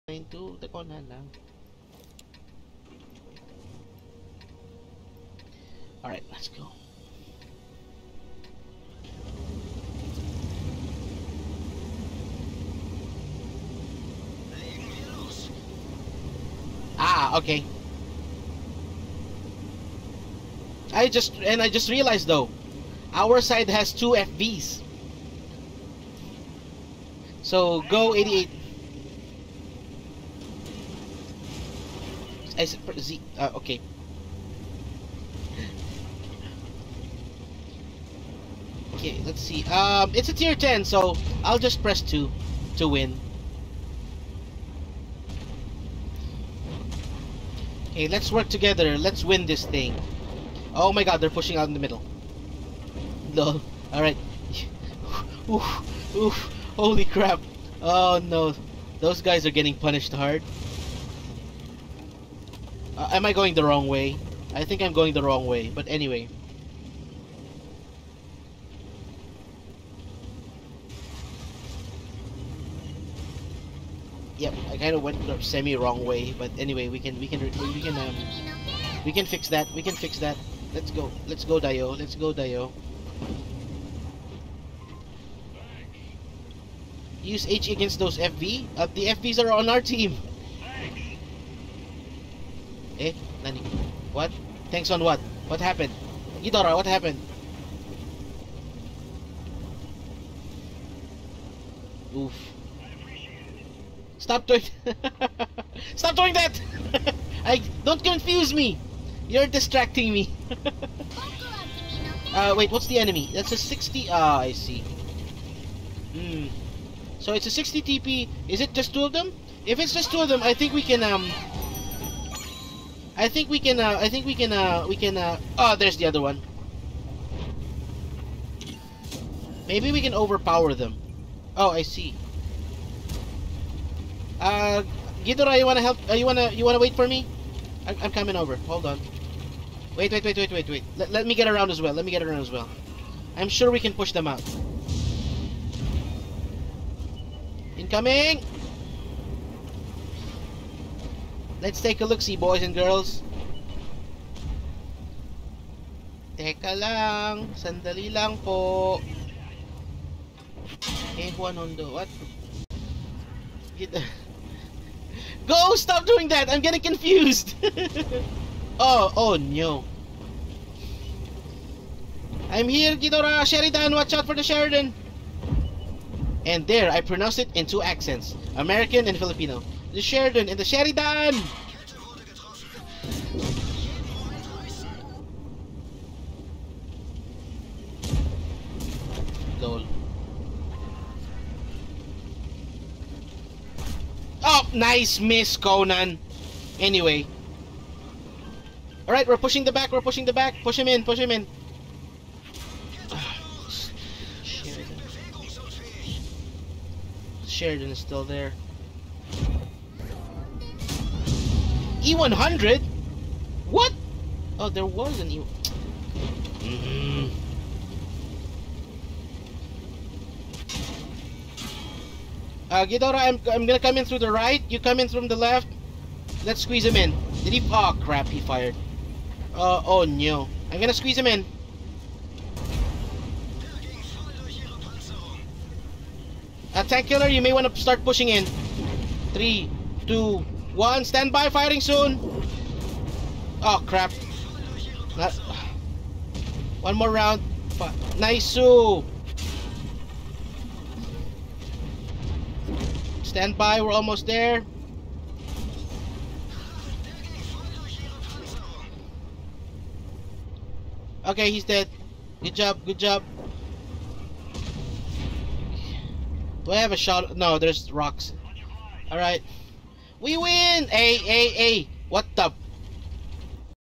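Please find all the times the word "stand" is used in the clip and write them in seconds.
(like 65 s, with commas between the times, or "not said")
241 s, 253 s.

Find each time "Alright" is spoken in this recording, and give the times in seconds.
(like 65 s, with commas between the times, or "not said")
6 s, 53 s, 199 s, 269 s.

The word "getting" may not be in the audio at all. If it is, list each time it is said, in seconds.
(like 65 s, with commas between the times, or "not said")
59 s, 166 s.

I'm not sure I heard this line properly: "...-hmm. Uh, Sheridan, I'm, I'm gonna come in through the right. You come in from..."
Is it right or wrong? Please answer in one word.
wrong.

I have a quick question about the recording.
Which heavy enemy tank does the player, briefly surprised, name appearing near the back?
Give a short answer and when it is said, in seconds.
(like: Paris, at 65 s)
E100, at 212 s.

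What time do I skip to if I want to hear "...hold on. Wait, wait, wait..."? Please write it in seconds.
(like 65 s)
138 s.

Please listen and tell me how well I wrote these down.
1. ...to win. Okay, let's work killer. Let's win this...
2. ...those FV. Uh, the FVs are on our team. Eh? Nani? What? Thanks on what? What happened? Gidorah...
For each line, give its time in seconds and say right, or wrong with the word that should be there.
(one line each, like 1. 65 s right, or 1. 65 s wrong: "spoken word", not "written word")
1. 42 s wrong: "together", not "killer"
2. 87 s right.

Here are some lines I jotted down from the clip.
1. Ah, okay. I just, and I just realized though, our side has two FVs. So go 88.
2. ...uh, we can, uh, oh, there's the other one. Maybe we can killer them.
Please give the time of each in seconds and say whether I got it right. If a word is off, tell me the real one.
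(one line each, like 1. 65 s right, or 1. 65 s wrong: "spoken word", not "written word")
1. 16 s right
2. 124 s wrong: "overpower", not "killer".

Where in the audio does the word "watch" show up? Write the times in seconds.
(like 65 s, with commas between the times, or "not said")
173 s.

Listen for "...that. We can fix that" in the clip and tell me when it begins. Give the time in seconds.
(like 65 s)
79 s.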